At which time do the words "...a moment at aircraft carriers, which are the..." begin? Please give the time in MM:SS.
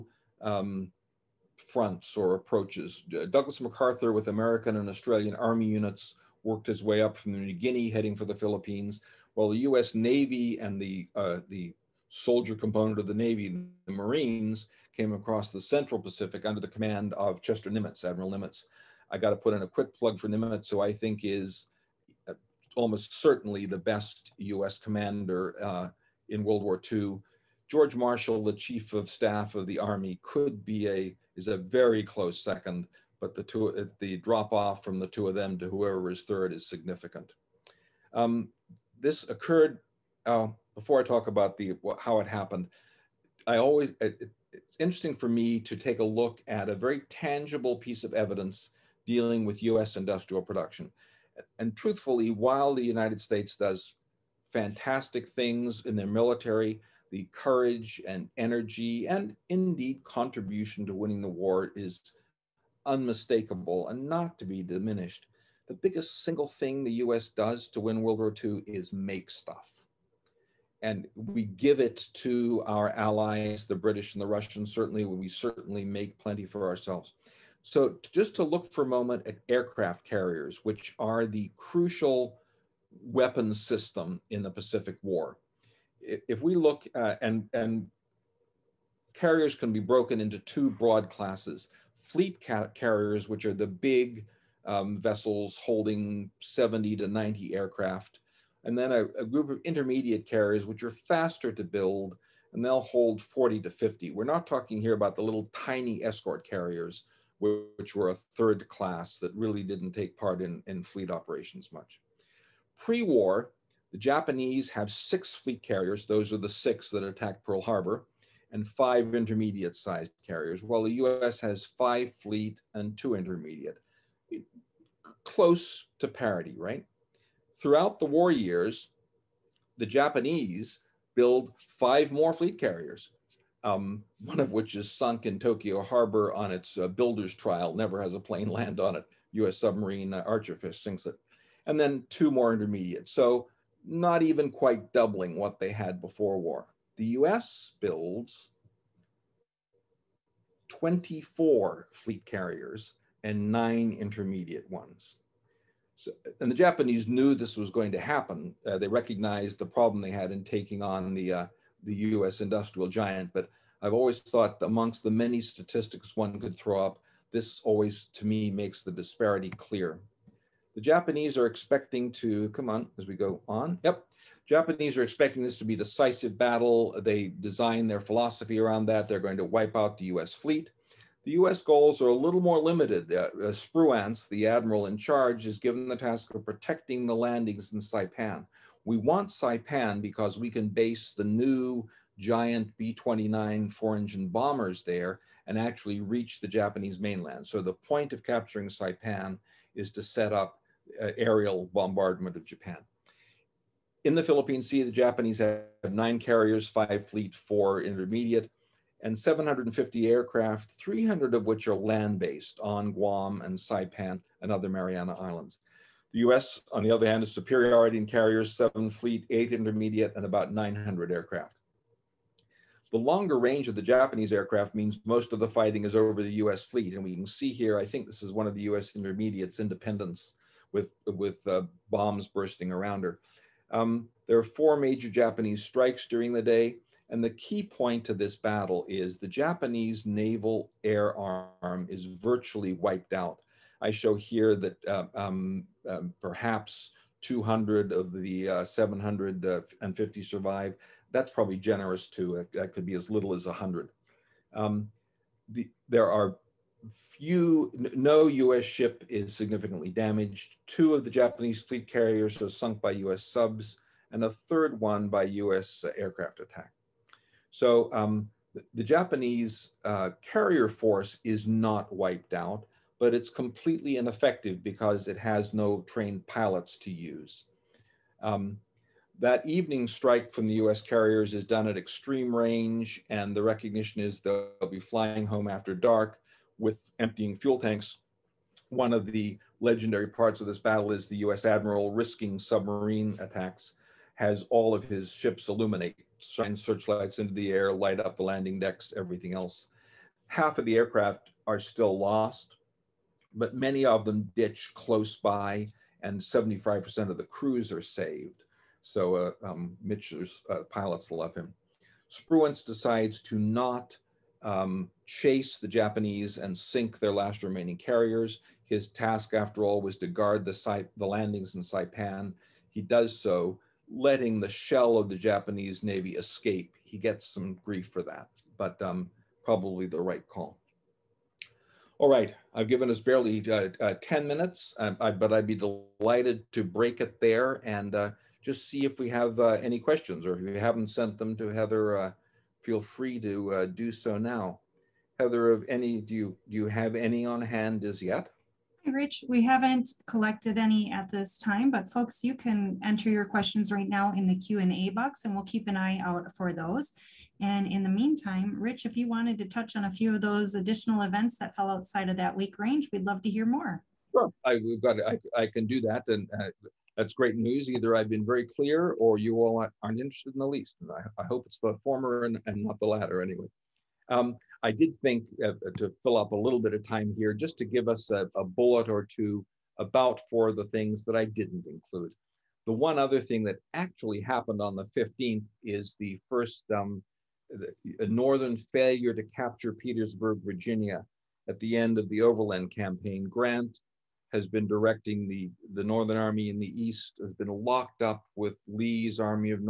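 01:18.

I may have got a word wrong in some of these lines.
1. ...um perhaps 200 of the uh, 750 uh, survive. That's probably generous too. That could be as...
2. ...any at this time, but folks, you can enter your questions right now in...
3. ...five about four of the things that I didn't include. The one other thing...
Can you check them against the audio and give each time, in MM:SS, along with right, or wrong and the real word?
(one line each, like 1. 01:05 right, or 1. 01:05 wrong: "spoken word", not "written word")
1. 04:05 right
2. 05:50 right
3. 06:19 wrong: "two", not "five".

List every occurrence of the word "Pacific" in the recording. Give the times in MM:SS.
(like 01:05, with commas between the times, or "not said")
00:15, 01:24.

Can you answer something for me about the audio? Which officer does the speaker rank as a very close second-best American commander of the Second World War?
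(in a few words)
George Marshall.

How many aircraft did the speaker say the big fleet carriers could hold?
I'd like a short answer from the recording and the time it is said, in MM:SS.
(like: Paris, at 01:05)
70 to 90, at 01:36.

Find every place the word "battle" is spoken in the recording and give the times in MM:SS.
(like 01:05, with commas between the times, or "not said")
02:56, 03:58, 04:50.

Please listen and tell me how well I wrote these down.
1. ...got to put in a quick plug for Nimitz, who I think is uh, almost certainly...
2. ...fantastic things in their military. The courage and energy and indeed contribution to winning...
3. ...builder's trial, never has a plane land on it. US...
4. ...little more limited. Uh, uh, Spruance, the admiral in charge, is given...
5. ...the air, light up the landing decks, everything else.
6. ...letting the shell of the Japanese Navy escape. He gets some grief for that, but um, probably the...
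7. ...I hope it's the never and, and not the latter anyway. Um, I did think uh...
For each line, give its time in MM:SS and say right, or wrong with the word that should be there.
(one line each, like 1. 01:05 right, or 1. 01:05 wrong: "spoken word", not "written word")
1. 00:19 right
2. 00:54 right
3. 02:16 right
4. 03:02 right
5. 04:57 right
6. 05:23 right
7. 06:11 wrong: "former", not "never".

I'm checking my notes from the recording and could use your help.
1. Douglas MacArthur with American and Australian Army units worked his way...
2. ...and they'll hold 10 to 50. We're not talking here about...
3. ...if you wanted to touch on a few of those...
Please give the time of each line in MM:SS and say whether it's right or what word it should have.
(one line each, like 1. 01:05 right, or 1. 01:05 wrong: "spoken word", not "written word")
1. 00:03 right
2. 01:42 wrong: "40", not "10"
3. 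05:58 right.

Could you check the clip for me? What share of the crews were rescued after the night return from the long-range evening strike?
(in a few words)
75%.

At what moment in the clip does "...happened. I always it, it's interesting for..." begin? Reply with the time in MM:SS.
00:42.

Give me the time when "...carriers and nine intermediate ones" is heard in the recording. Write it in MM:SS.
02:32.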